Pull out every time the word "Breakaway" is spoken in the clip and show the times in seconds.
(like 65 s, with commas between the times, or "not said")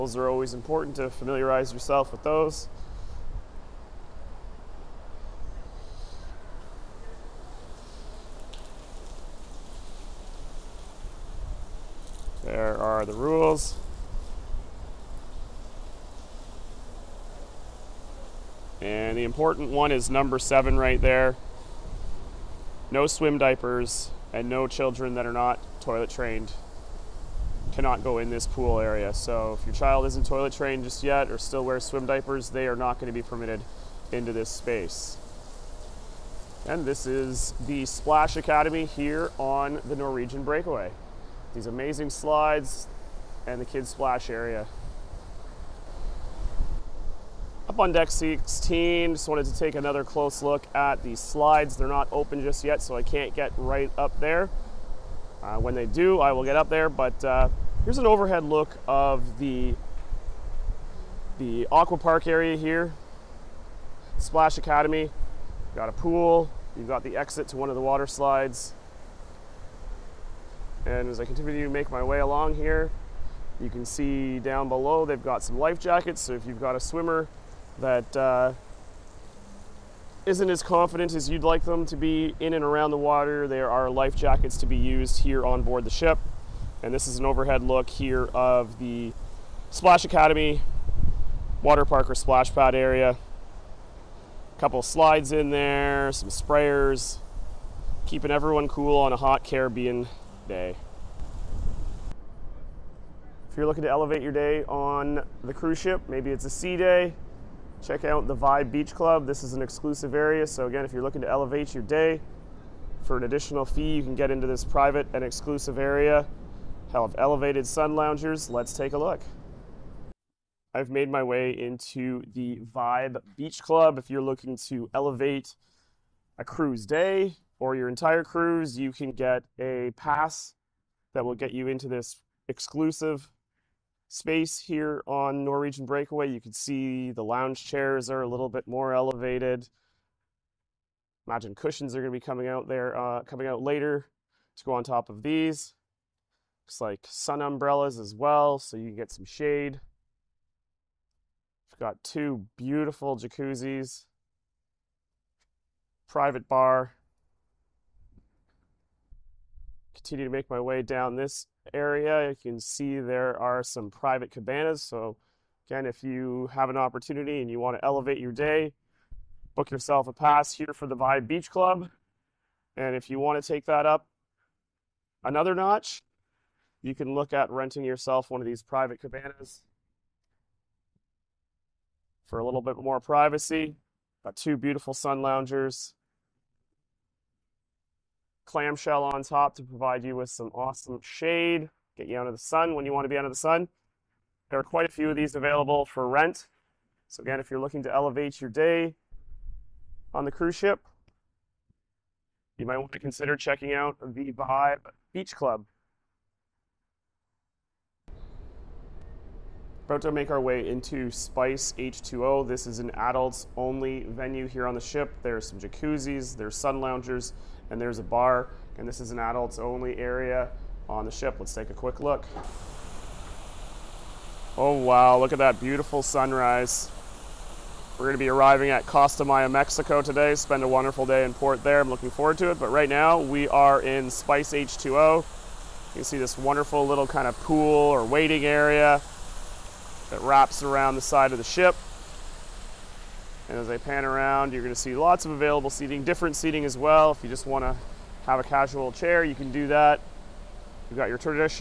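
40 s, 135 s.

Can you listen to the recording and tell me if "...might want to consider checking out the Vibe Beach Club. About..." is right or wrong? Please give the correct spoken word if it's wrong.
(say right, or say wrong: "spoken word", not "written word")
right.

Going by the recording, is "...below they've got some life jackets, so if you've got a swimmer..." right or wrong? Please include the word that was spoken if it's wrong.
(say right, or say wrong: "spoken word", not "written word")
right.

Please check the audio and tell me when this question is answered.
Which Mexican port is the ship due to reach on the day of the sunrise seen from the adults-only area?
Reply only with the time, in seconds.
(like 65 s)
228 s.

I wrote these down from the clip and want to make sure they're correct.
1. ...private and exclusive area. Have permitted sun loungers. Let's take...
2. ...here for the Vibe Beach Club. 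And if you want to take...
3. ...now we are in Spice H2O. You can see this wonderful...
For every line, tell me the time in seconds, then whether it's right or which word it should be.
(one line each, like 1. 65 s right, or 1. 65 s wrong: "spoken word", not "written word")
1. 114 s wrong: "elevated", not "permitted"
2. 170 s right
3. 232 s right.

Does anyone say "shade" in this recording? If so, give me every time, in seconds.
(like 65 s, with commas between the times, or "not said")
149 s, 191 s.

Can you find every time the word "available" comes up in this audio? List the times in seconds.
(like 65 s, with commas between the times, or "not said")
195 s, 245 s.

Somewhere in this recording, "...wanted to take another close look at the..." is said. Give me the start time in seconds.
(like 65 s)
49 s.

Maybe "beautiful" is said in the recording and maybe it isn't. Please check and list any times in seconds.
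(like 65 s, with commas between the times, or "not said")
152 s, 184 s, 225 s.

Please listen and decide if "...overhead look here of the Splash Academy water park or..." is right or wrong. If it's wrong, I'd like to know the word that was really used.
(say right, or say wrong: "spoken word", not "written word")
right.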